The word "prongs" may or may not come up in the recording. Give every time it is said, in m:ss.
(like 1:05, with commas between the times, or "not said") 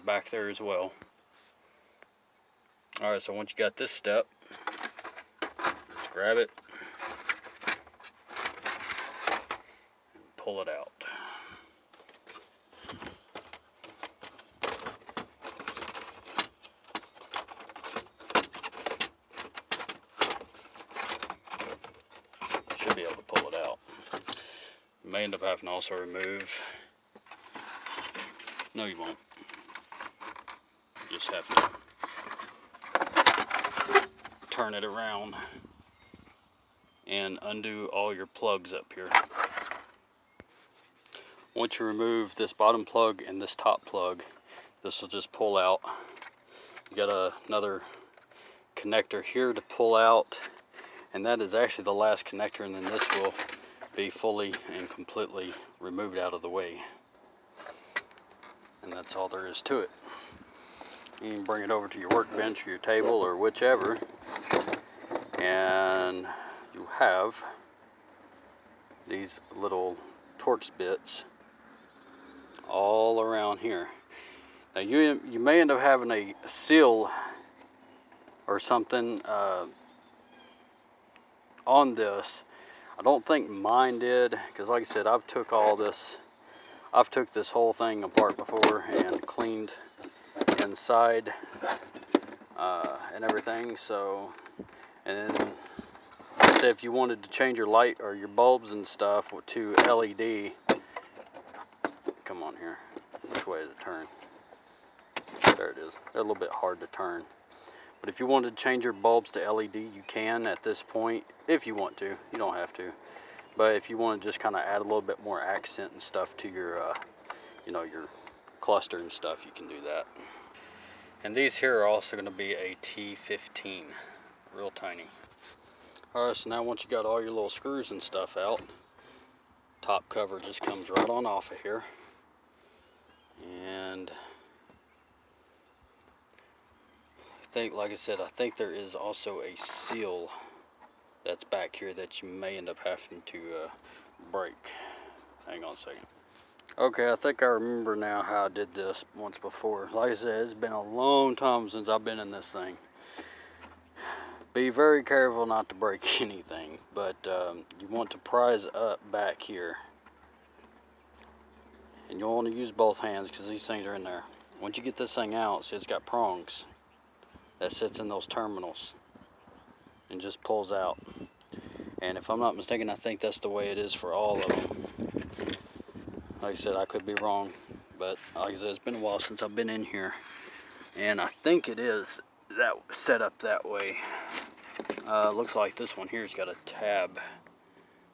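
2:46.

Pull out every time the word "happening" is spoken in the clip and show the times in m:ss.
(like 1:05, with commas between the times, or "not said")
not said.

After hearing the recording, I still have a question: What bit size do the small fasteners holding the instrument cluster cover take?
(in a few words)
T15.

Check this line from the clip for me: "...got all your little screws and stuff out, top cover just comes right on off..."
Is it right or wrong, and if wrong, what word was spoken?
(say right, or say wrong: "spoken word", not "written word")
right.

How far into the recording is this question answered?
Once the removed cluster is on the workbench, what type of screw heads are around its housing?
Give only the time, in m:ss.
1:10.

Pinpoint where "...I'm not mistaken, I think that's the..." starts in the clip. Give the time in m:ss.
2:52.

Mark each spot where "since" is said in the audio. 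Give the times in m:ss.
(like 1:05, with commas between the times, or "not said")
2:31, 2:59.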